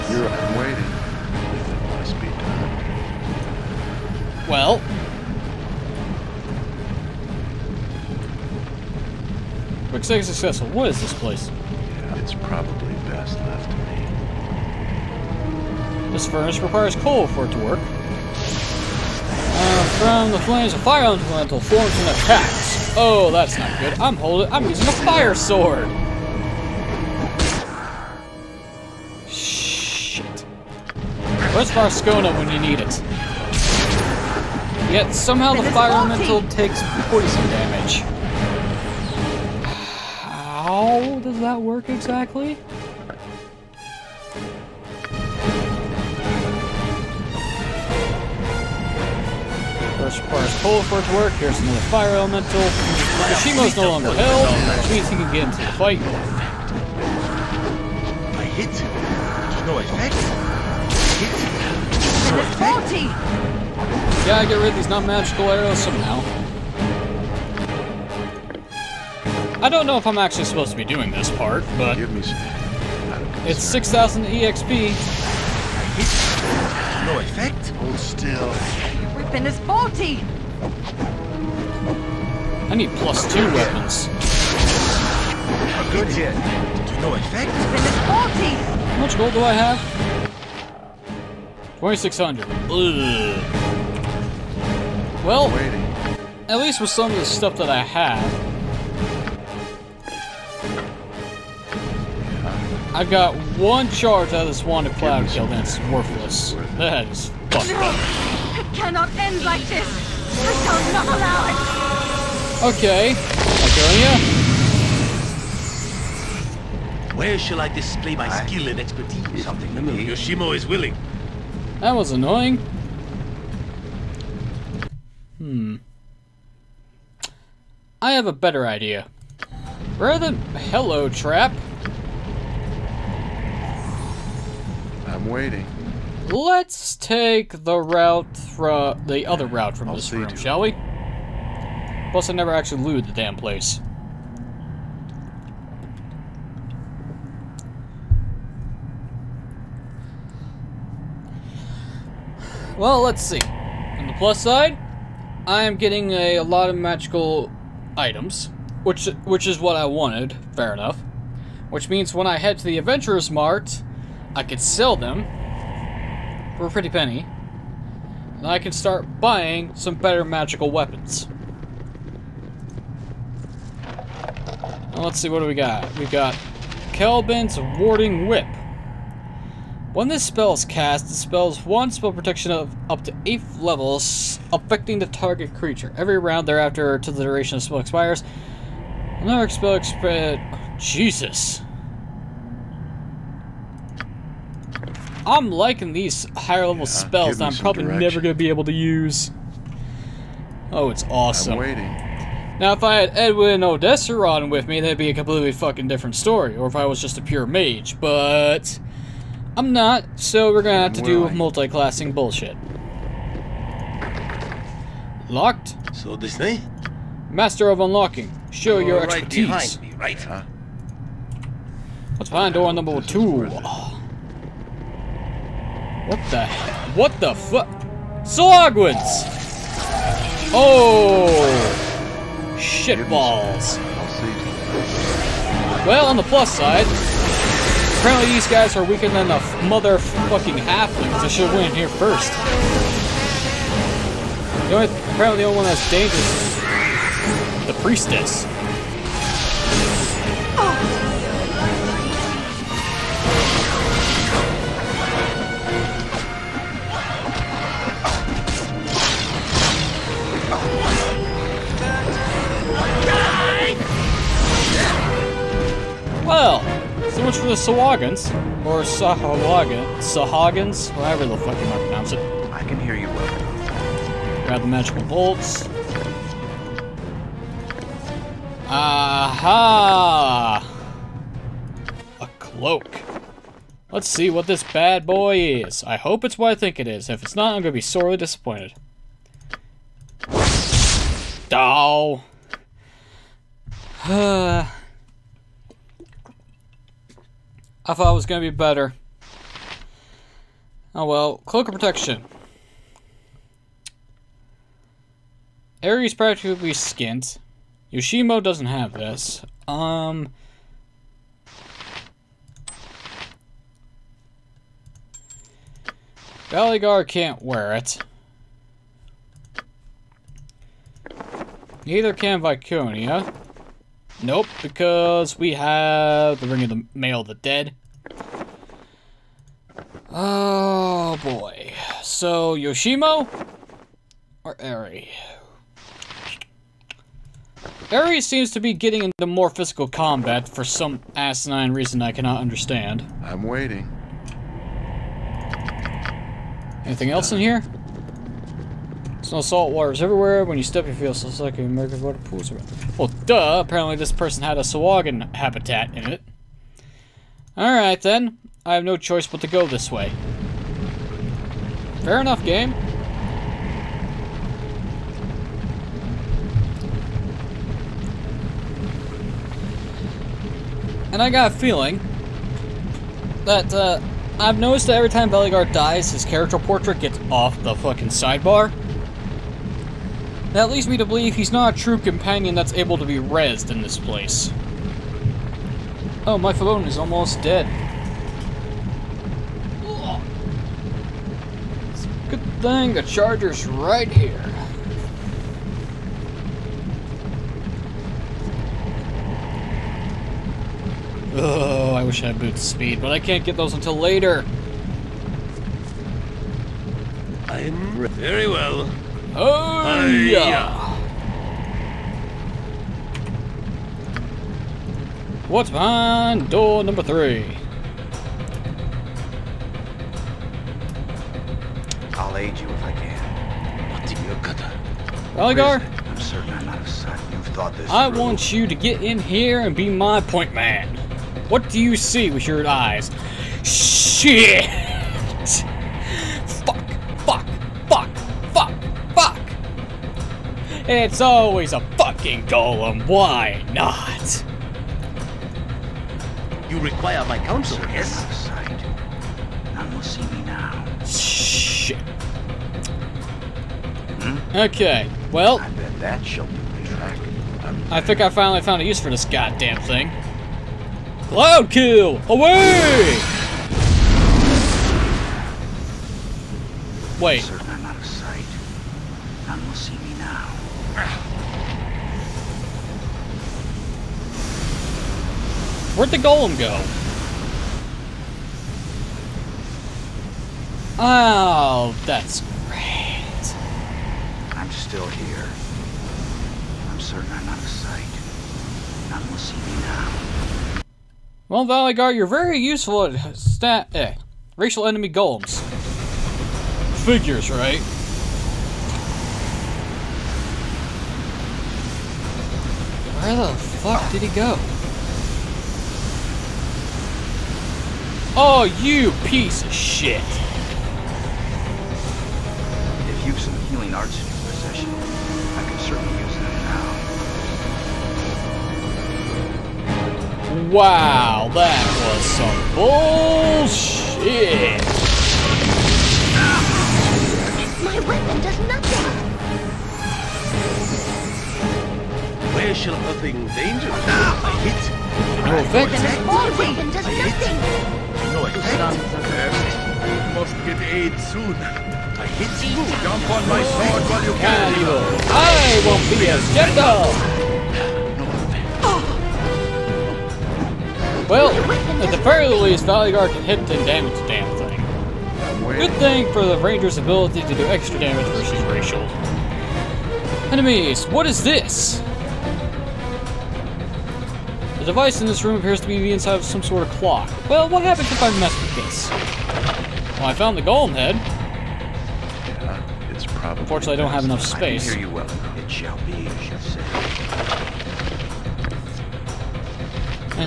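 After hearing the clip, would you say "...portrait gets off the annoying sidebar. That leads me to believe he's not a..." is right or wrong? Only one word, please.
wrong.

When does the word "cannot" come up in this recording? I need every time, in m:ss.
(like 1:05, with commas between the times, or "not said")
1:48, 5:42.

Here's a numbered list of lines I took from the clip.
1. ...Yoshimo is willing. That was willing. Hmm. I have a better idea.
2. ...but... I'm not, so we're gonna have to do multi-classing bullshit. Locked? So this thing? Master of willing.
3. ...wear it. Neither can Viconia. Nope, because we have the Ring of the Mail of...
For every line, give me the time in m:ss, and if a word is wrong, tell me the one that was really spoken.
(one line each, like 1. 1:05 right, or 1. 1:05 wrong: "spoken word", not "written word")
1. 1:59 wrong: "annoying", not "willing"
2. 3:27 wrong: "unlocking", not "willing"
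3. 5:17 right.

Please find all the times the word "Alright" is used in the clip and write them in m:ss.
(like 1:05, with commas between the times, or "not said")
5:57.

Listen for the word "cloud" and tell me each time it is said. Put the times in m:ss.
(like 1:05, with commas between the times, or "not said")
1:44, 7:41.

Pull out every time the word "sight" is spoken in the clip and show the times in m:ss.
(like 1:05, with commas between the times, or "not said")
7:06, 8:07.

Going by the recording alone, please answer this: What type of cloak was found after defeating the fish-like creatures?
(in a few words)
Cloak of Protection.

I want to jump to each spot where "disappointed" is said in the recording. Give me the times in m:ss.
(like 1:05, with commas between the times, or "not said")
4:48.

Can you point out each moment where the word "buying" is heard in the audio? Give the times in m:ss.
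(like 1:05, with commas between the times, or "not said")
2:49.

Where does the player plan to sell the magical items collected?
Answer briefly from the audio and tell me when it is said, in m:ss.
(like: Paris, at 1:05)
Adventurers Mart, at 2:42.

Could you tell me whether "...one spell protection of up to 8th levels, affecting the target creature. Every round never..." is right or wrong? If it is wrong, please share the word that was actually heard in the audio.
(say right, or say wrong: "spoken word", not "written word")
wrong: "thereafter", not "never".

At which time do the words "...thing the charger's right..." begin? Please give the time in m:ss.
6:32.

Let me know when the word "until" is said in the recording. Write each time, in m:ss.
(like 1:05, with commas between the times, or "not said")
6:43.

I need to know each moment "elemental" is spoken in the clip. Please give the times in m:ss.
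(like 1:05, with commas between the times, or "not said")
0:21, 0:35, 0:52.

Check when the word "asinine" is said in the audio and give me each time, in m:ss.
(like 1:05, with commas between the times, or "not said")
5:41.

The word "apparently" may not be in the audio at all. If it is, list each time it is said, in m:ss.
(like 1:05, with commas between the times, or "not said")
3:57, 4:05, 5:53.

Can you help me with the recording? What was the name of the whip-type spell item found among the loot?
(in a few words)
Khelben's Warding Whip.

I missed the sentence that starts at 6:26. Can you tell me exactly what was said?
Oh, my phone is almost dead.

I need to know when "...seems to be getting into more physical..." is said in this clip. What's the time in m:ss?
5:38.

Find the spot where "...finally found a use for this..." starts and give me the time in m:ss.
7:38.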